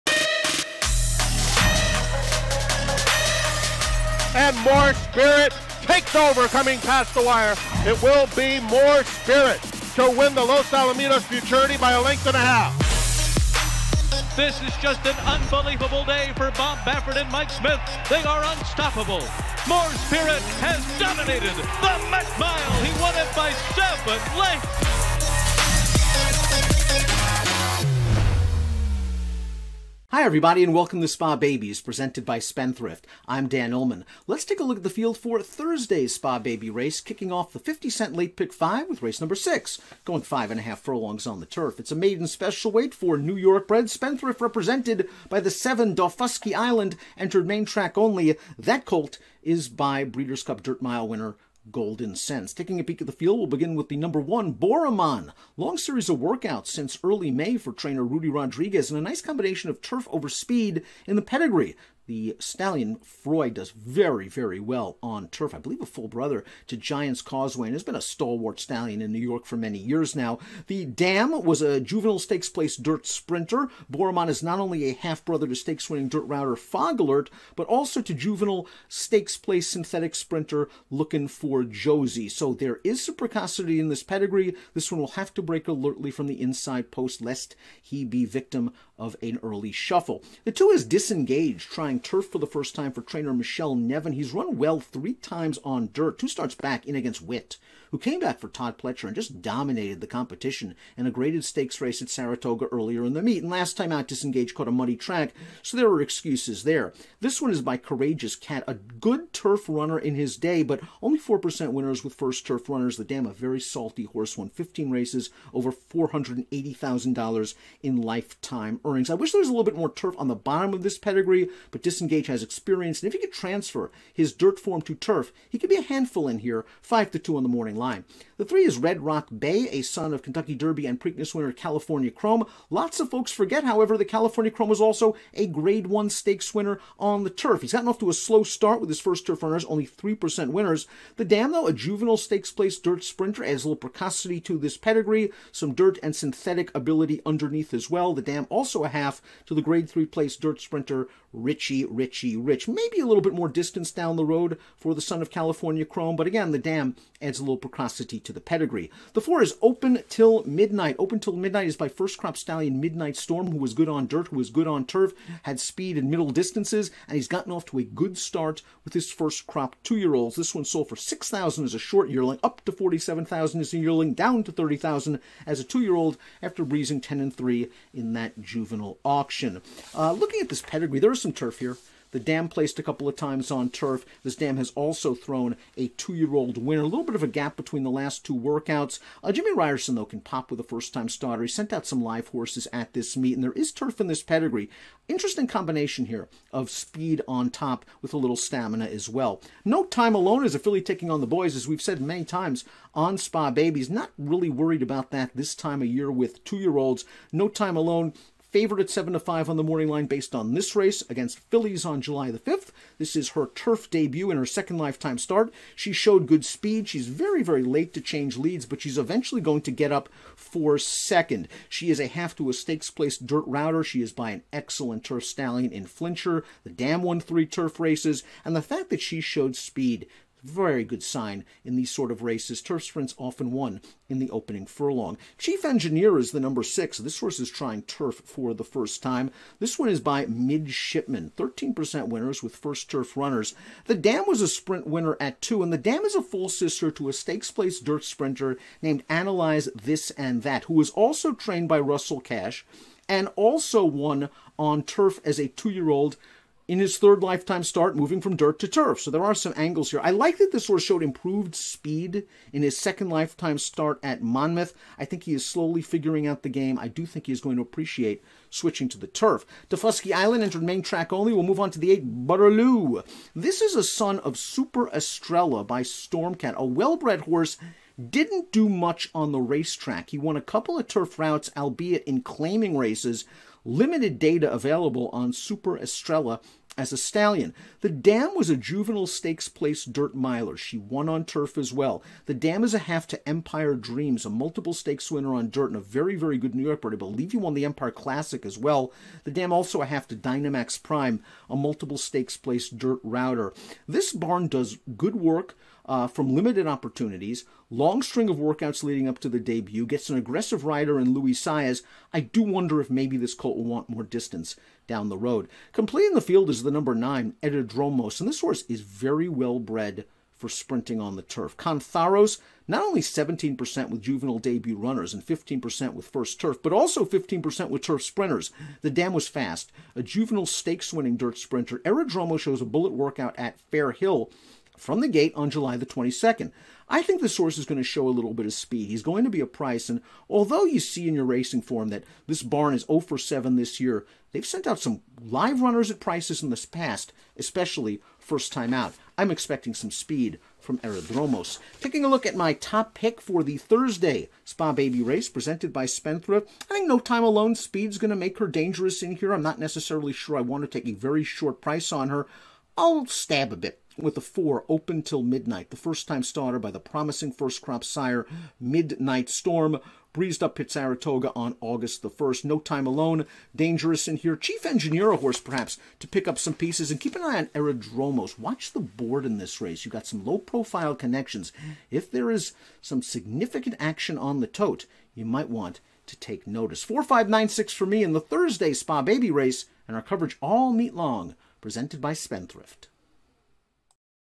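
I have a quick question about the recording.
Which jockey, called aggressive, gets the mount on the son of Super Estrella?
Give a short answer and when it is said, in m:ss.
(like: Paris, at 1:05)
Luis Saez, at 5:11.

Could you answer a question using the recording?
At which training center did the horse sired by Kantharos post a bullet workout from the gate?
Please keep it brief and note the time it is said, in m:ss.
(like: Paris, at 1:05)
Fair Hill, at 5:33.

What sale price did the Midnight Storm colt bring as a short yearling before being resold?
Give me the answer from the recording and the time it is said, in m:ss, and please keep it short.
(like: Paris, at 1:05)
6000, at 2:50.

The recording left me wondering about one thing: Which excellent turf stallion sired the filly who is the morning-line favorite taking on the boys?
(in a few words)
Flintshire.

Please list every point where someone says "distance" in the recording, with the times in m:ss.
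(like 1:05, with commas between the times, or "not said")
2:33, 2:46, 5:14.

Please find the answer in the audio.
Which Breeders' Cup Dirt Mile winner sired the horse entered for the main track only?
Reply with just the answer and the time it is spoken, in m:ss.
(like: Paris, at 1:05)
Goldencents, at 0:51.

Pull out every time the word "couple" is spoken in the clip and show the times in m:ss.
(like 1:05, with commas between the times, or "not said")
3:02, 4:40.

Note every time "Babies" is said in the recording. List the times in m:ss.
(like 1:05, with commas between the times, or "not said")
0:31, 3:23.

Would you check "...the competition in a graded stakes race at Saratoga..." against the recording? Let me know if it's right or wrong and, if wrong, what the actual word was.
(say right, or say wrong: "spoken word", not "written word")
right.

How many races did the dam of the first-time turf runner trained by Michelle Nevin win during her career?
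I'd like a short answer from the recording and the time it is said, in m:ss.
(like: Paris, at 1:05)
15, at 1:54.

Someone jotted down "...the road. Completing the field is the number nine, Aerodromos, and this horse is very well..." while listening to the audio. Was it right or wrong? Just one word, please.
right.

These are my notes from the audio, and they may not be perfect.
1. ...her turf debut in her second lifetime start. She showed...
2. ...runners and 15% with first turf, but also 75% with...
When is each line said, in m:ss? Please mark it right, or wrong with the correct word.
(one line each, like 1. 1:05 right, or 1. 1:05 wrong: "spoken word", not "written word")
1. 3:33 right
2. 5:24 wrong: "15", not "75".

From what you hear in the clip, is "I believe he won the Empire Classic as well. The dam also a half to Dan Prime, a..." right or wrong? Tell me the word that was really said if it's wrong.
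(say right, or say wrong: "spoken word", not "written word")
wrong: "Dynamax", not "Dan".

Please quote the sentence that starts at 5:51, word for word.
Taking a look at my top pick for the Thursday Spa Baby race presented by Spendthrift.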